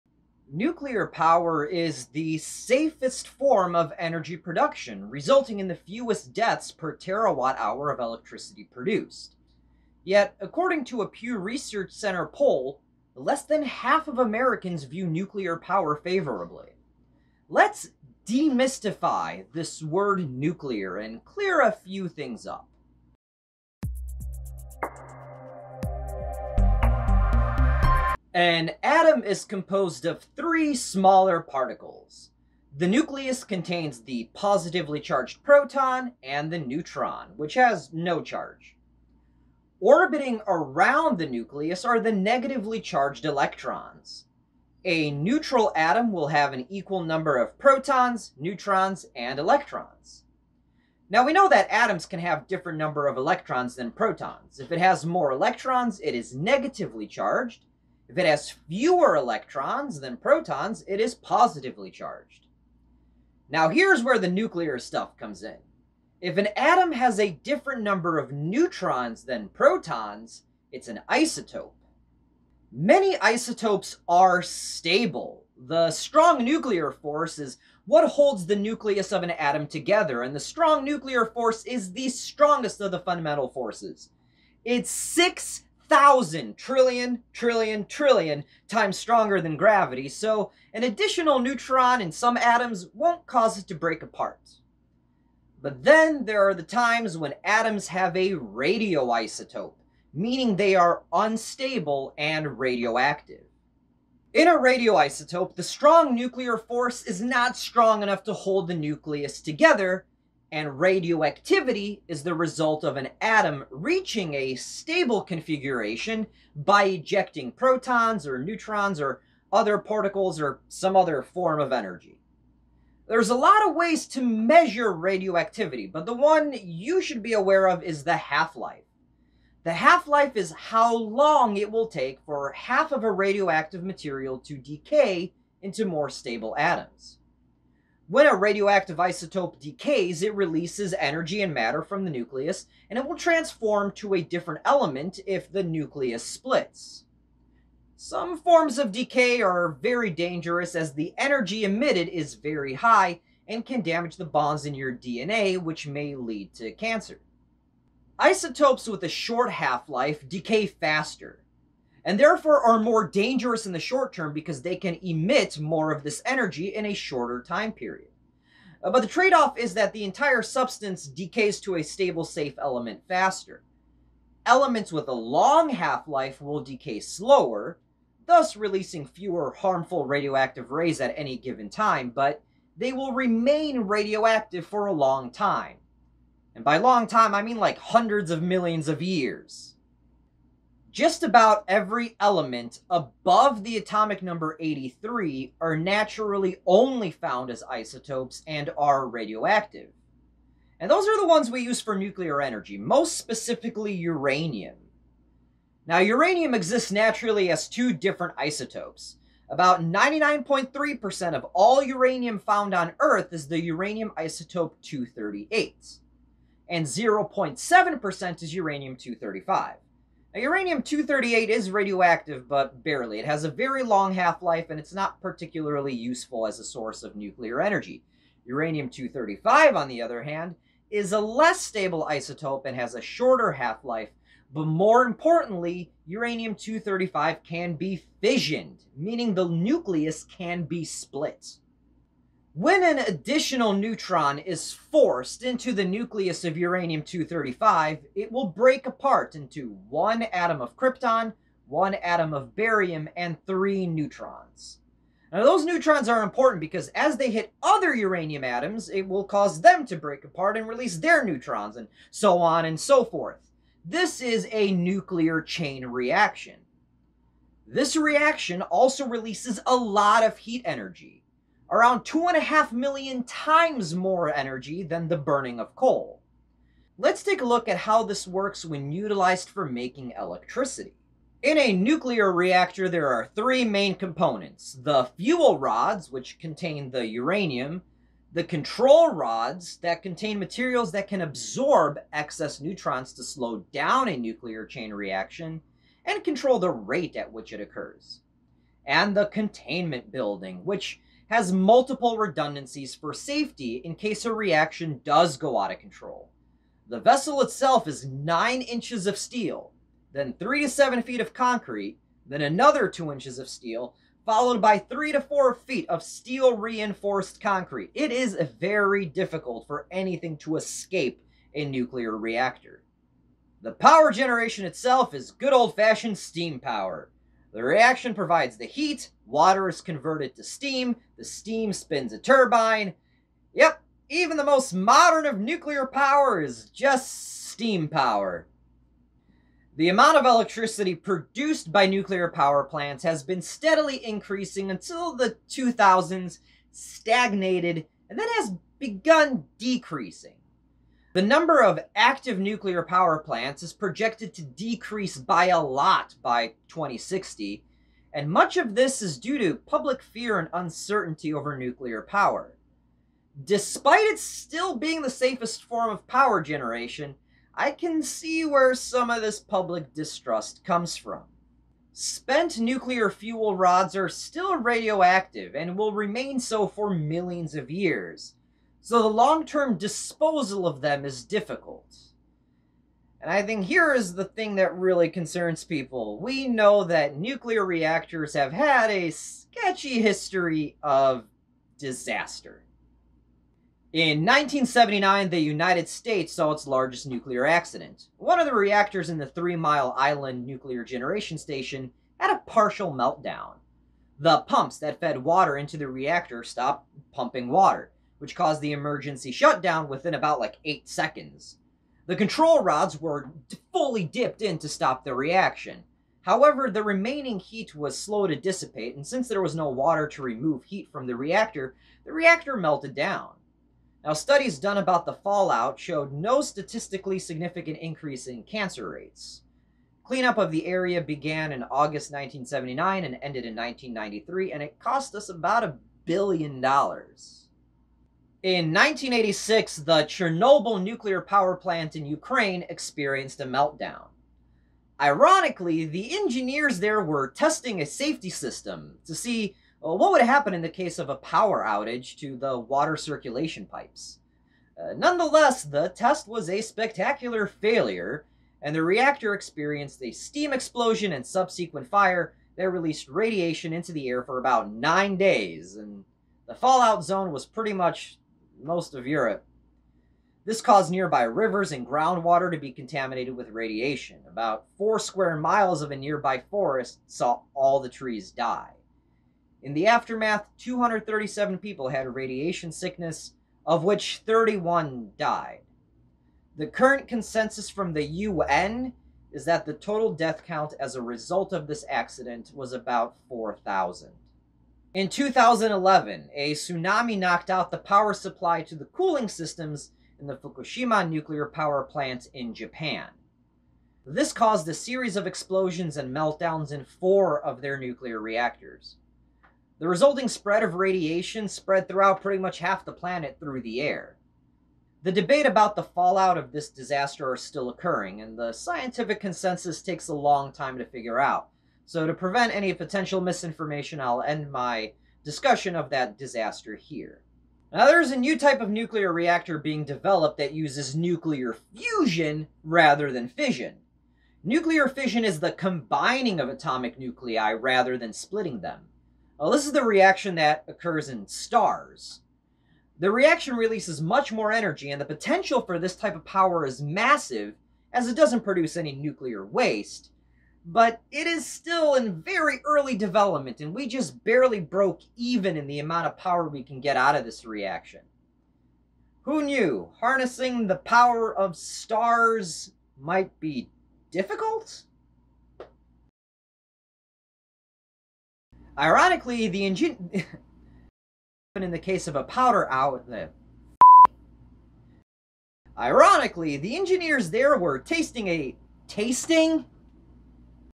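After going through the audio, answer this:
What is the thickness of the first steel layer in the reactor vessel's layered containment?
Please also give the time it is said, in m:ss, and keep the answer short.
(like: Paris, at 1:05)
9 inches, at 5:08.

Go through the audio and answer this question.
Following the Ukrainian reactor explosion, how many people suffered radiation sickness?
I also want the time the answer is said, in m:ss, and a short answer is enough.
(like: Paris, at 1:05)
237, at 8:00.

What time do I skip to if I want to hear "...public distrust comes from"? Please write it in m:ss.
6:09.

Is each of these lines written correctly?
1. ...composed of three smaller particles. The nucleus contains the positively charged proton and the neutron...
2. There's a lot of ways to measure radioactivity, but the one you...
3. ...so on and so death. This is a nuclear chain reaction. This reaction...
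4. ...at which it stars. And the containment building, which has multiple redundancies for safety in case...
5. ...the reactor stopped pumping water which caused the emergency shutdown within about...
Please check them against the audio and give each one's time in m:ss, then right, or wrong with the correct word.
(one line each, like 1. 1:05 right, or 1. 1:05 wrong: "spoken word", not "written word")
1. 0:29 right
2. 2:03 right
3. 4:22 wrong: "forth", not "death"
4. 4:57 wrong: "occurs", not "stars"
5. 6:45 right.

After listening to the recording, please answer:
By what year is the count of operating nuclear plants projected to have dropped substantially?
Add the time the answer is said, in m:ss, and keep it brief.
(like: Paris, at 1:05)
2060, at 5:56.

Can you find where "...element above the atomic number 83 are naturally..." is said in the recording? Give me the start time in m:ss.
3:12.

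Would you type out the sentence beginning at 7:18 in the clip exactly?
In 1986, the Chernobyl nuclear power plant in Ukraine experienced a meltdown.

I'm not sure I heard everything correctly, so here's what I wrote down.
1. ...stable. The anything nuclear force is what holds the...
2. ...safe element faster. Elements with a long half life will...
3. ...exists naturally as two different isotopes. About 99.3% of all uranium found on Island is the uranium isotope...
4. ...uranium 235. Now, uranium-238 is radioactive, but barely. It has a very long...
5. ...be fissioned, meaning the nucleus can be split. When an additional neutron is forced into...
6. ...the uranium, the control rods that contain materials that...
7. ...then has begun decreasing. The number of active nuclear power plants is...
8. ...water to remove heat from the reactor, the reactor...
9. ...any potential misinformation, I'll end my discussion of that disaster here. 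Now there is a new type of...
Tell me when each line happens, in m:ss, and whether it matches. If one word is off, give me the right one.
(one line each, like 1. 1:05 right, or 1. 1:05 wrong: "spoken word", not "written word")
1. 1:14 wrong: "strong", not "anything"
2. 2:52 right
3. 3:26 wrong: "Earth", not "Island"
4. 3:38 right
5. 3:57 right
6. 4:46 right
7. 5:48 right
8. 6:59 right
9. 8:42 right.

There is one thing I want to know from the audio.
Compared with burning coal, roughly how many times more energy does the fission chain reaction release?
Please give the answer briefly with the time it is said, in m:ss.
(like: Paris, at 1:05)
2.5 million, at 4:32.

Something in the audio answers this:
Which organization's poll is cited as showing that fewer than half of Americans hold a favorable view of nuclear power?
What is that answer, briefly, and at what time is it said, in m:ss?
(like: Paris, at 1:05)
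Pew Research Center, at 0:11.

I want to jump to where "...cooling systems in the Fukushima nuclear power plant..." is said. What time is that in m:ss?
8:18.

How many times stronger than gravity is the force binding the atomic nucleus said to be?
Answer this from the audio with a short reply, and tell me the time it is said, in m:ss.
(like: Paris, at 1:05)
6,000 trillion trillion trillion, at 1:24.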